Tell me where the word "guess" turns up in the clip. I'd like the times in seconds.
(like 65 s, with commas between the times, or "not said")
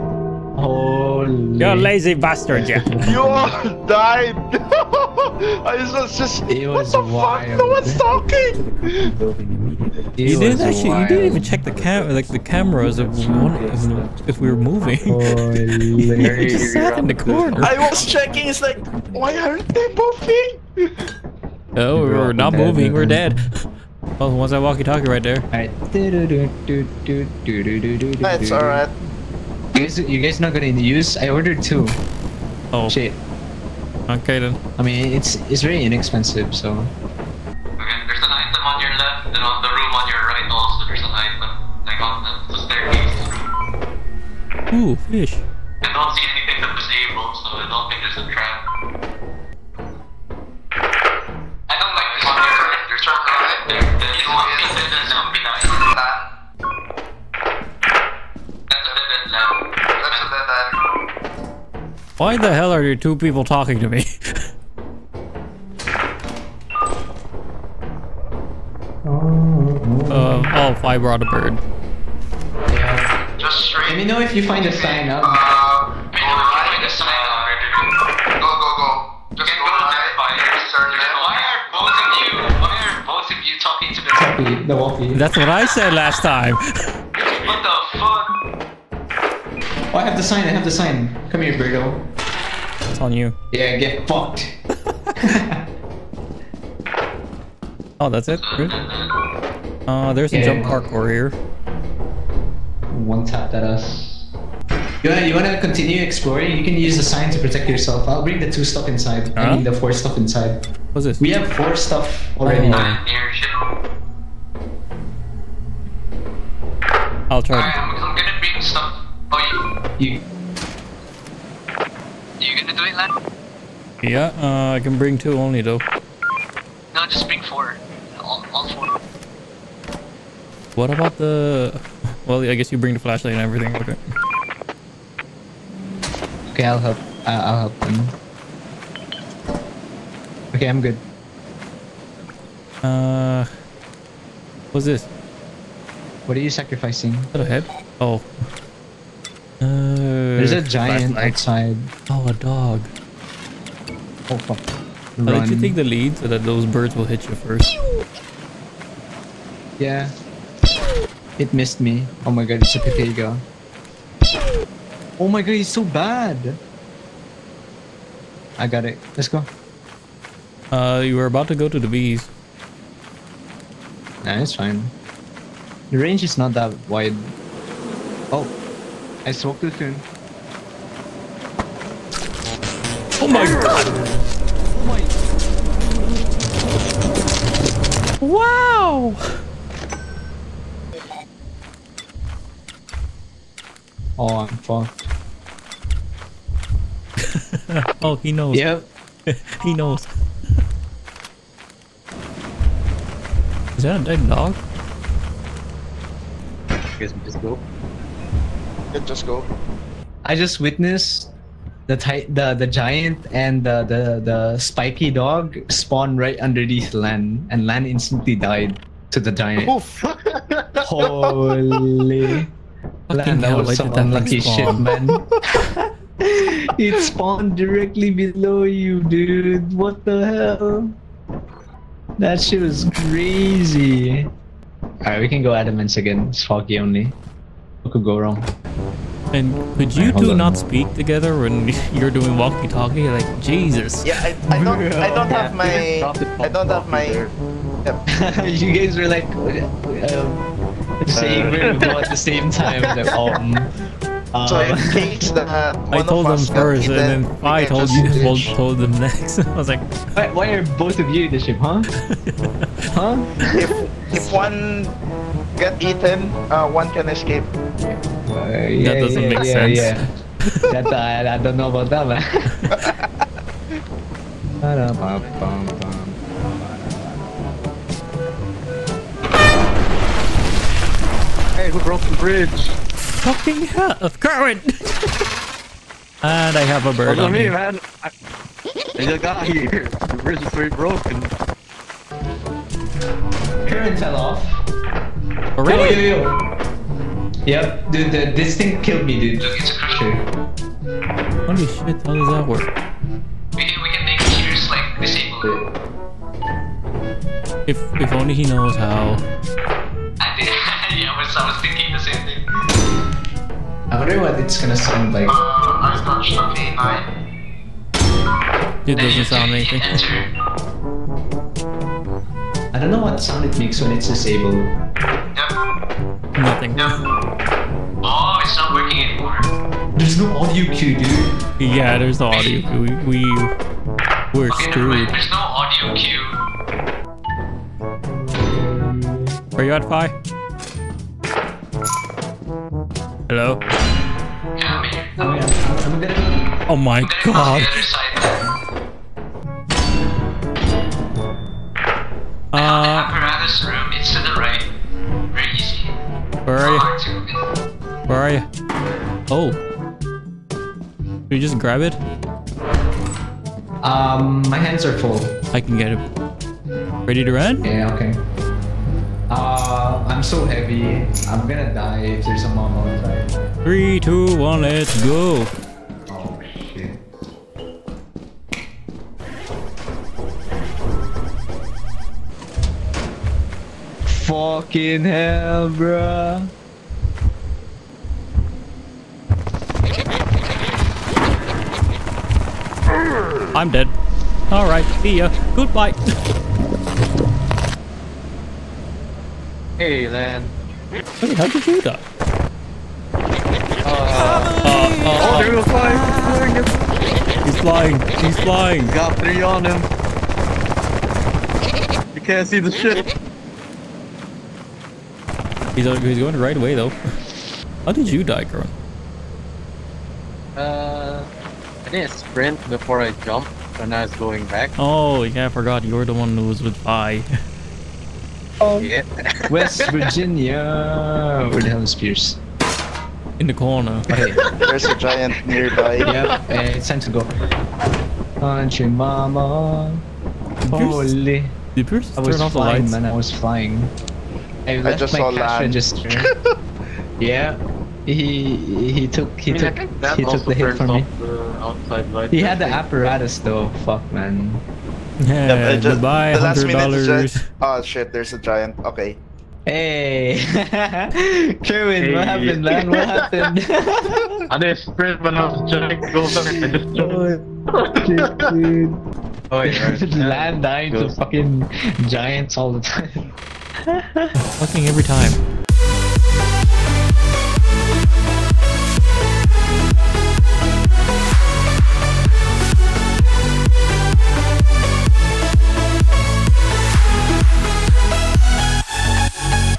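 132 s, 206 s.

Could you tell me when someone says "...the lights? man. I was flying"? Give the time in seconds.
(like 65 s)
442 s.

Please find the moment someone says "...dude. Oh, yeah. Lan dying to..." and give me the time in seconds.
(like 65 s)
468 s.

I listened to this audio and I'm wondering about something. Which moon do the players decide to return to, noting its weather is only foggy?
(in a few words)
Adamance.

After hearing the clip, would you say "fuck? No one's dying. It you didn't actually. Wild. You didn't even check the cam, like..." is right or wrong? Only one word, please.
wrong.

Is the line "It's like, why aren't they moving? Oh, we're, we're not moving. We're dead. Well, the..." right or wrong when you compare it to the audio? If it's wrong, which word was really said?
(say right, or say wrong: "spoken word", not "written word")
right.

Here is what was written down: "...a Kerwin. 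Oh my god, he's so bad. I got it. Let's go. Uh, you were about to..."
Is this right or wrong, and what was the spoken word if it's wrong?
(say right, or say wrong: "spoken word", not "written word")
wrong: "Pepega", not "Kerwin".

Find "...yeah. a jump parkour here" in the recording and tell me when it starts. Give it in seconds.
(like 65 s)
100 s.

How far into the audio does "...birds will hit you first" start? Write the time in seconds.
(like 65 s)
156 s.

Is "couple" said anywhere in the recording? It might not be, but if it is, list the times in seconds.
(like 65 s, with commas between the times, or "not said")
not said.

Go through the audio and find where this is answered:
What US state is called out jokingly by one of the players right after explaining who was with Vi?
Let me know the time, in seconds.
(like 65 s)
429 s.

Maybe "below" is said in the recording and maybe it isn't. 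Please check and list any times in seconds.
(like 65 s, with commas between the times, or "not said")
228 s.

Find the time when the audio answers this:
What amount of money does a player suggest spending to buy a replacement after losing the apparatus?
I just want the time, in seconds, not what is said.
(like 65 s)
456 s.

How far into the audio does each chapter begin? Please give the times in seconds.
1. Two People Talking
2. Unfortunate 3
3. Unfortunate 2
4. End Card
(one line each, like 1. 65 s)
1. 37 s
2. 388 s
3. 169 s
4. 469 s.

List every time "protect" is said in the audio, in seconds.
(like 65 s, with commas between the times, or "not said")
107 s.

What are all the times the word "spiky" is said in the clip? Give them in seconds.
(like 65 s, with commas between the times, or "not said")
214 s.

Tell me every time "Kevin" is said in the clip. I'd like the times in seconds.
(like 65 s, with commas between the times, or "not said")
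461 s.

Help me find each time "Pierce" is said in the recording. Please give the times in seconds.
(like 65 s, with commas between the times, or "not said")
431 s, 441 s.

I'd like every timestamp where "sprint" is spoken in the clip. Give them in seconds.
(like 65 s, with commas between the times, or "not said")
422 s, 464 s.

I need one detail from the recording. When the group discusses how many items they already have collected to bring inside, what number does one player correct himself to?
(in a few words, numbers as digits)
4.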